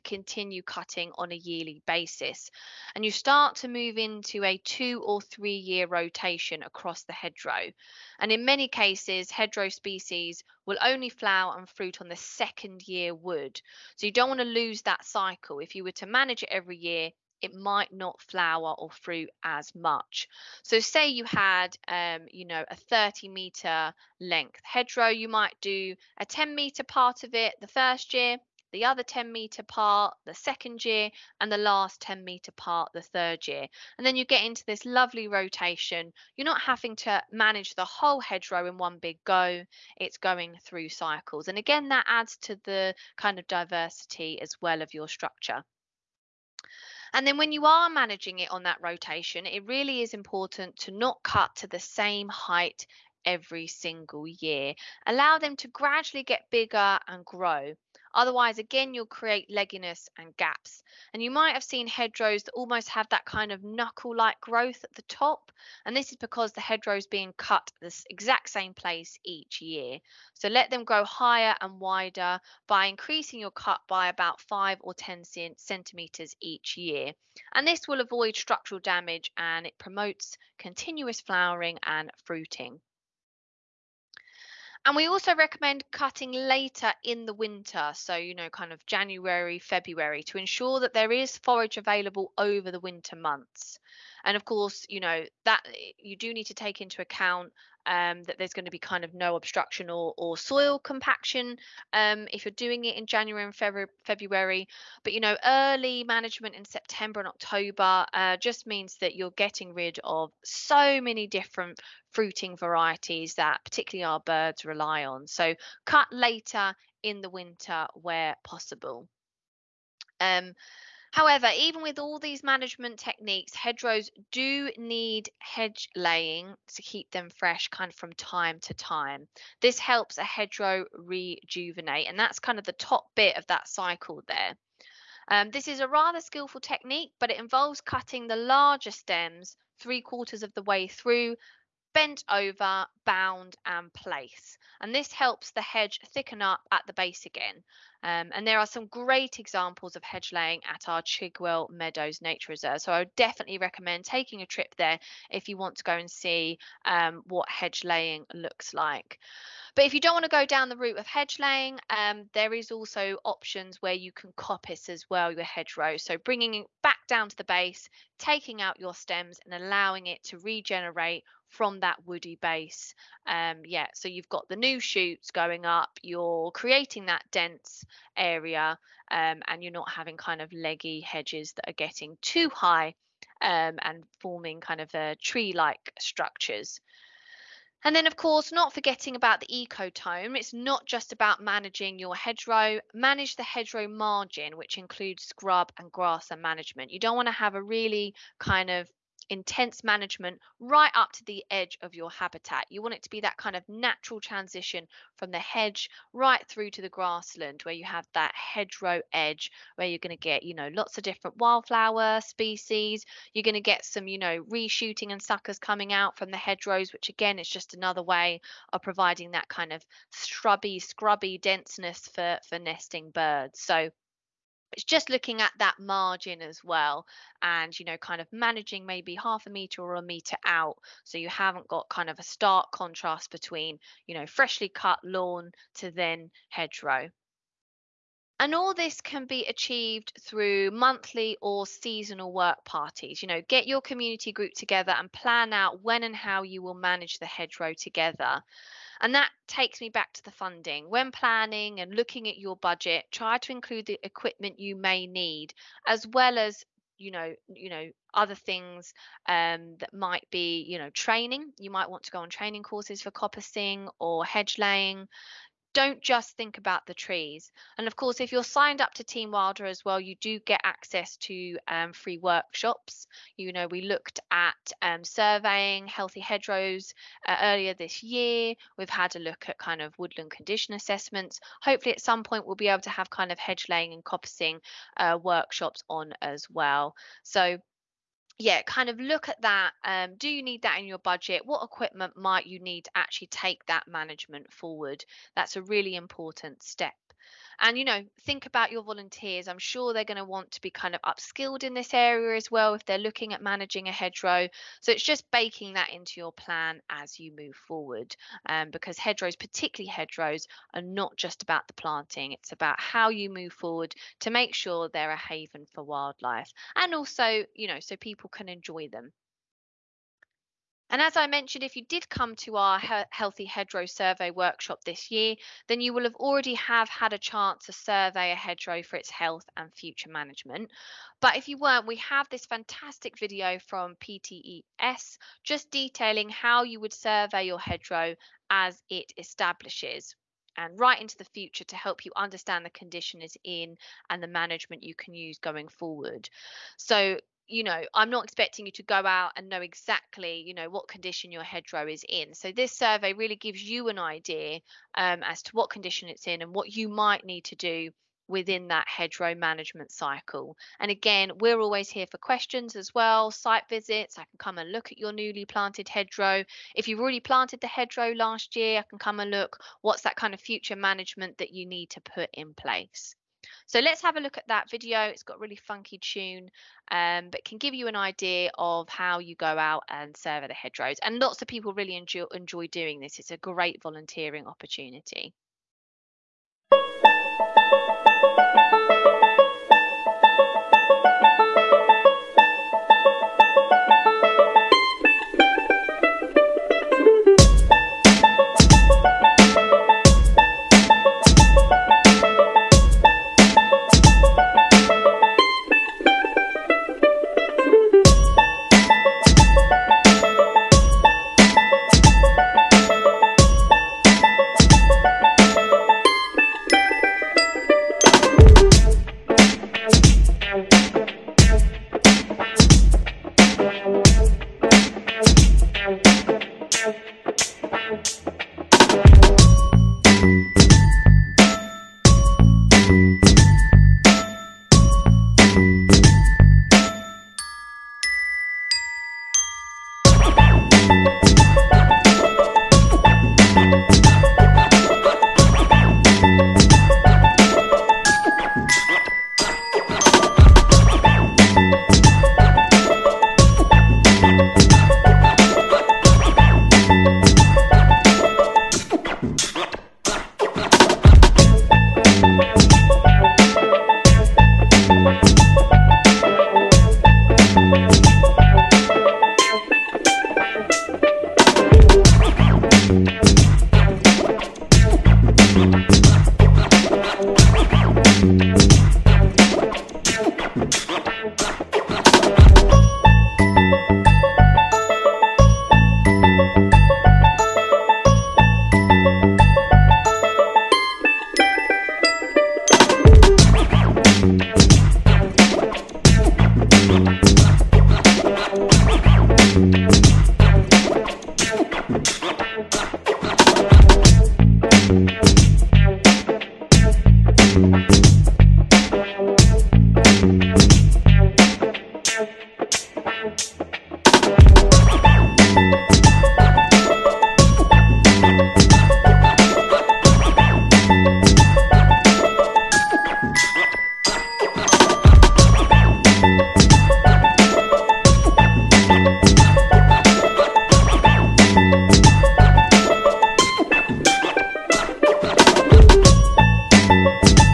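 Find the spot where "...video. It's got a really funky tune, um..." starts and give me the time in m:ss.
6:14.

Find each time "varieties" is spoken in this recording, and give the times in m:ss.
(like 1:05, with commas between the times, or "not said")
1:52.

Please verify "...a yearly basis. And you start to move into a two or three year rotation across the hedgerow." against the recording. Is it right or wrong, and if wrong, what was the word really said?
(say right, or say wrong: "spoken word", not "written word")
right.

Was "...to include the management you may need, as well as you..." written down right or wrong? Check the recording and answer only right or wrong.
wrong.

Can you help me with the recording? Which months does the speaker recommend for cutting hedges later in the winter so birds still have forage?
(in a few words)
January, February.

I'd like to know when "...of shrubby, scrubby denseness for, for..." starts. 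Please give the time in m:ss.
3:39.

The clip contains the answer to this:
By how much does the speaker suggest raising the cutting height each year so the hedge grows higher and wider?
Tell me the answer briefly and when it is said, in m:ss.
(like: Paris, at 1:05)
5 or 10 centimeters, at 1:14.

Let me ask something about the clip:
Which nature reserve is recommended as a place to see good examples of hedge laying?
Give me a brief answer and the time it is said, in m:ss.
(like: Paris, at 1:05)
Chigwell Meadows, at 2:31.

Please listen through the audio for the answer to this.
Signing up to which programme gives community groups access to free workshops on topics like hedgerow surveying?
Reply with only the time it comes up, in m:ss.
4:29.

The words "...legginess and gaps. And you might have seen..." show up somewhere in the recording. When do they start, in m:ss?
0:59.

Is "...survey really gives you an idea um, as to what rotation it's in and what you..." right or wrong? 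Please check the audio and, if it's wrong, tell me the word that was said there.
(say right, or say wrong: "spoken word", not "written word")
wrong: "condition", not "rotation".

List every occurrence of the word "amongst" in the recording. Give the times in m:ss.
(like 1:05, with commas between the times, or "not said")
not said.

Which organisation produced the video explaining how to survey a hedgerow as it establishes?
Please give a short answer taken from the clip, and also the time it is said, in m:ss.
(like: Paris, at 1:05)
PTES, at 5:33.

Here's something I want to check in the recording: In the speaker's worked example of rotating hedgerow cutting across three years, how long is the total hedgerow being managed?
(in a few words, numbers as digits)
30 meters.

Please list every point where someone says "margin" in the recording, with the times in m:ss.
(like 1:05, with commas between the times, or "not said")
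3:13, 3:45.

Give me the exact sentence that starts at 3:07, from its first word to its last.
And then, of course, not forgetting about the ecotone.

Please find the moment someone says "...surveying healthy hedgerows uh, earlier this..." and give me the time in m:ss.
4:35.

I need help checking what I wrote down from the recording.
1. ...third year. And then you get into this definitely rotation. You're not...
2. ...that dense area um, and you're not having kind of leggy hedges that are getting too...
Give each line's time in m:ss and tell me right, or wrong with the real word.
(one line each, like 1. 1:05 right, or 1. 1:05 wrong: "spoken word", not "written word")
1. 0:33 wrong: "lovely", not "definitely"
2. 2:57 right.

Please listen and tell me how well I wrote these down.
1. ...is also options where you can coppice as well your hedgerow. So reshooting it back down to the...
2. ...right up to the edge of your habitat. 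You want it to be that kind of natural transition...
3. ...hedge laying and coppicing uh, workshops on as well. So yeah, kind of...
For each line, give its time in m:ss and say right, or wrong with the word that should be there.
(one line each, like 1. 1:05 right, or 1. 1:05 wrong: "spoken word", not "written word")
1. 2:42 wrong: "bringing", not "reshooting"
2. 3:20 right
3. 4:43 right.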